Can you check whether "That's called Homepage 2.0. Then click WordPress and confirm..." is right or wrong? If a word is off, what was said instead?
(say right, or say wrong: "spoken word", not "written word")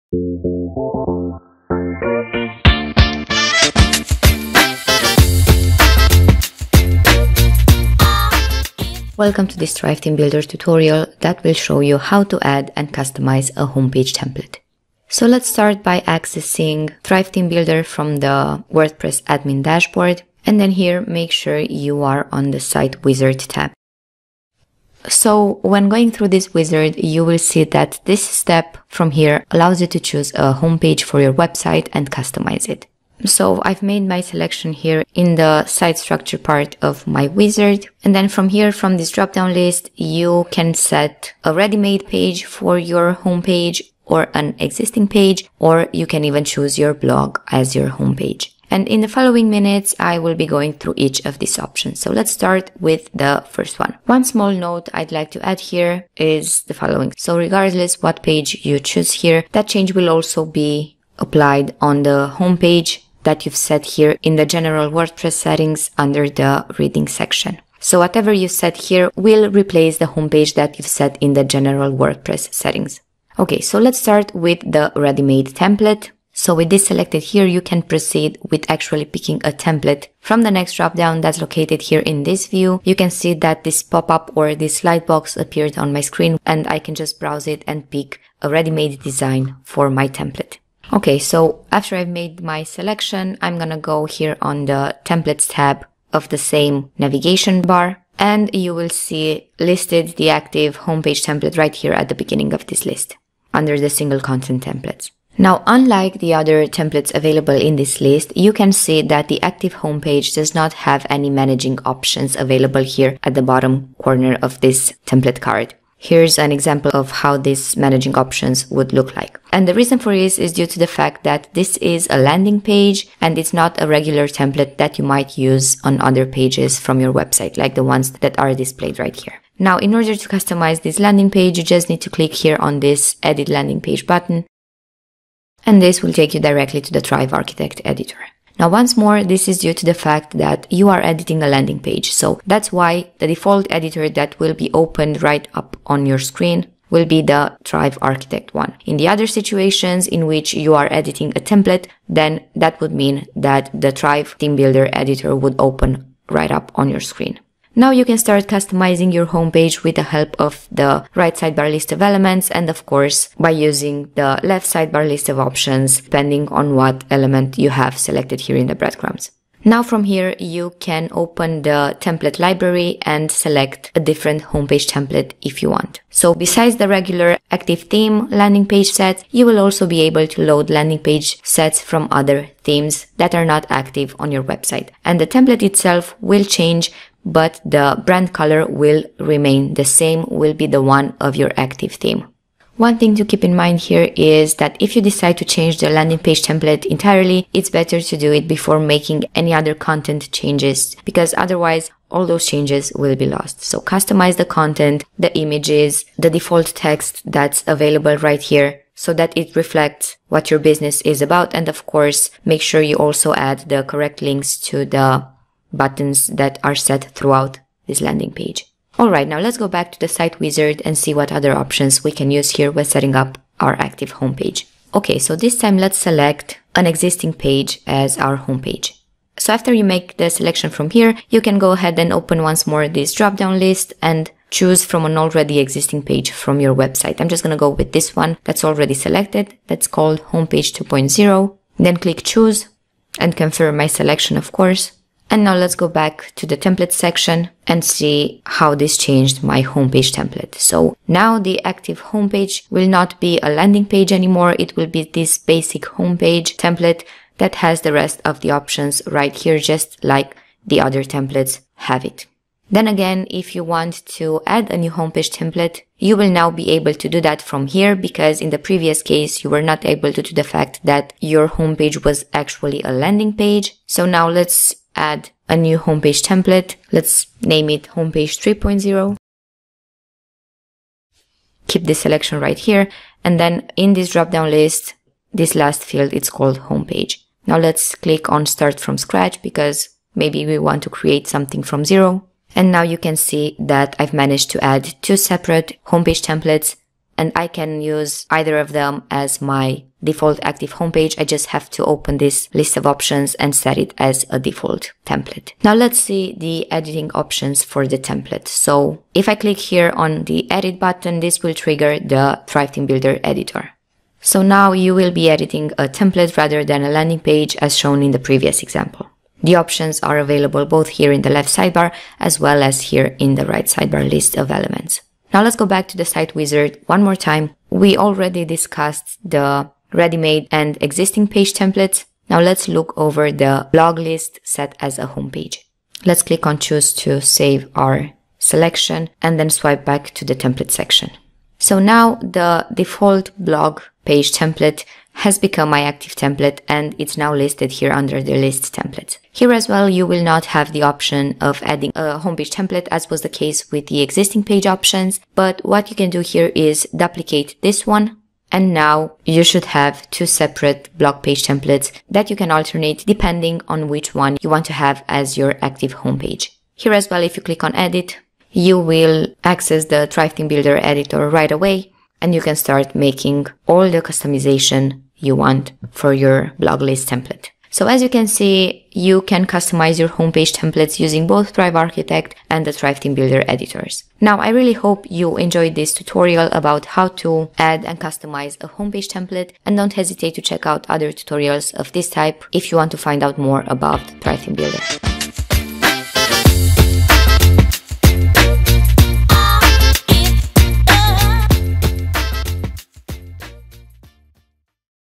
wrong: "Choose", not "WordPress".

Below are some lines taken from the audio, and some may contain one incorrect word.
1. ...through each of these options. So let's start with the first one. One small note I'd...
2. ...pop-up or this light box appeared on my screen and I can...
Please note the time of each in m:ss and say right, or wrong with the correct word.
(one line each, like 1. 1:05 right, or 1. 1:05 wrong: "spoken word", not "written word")
1. 0:50 right
2. 1:23 right.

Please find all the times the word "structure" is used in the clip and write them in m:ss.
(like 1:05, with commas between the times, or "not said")
0:35.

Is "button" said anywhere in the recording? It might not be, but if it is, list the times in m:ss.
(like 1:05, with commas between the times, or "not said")
2:14, 3:35, 5:10.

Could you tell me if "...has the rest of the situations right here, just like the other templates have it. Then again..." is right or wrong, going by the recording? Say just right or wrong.
wrong.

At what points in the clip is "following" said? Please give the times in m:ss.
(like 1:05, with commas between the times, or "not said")
0:49, 0:56.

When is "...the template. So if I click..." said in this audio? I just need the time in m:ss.
5:07.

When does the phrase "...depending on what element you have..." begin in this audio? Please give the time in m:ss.
2:46.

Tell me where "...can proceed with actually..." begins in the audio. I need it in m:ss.
1:17.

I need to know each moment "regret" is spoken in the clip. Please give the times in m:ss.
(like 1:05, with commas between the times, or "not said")
not said.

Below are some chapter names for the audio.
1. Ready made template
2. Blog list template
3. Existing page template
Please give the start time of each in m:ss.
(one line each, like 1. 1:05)
1. 0:49
2. 5:28
3. 3:45.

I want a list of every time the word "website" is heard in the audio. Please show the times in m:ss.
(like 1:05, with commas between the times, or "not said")
0:31, 2:07, 3:04, 3:56.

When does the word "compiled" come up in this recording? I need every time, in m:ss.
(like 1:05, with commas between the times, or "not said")
not said.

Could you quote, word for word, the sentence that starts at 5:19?
The options are available both here in the left sidebar as well as here in the right sidebar list of elements.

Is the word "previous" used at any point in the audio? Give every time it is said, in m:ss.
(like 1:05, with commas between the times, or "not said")
4:28, 5:18.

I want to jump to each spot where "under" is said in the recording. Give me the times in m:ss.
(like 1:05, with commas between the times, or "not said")
1:05, 1:43, 5:47.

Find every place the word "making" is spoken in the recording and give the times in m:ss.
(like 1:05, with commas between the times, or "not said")
3:18, 6:12.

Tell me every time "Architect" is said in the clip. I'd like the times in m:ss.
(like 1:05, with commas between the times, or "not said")
2:17, 2:28, 6:21.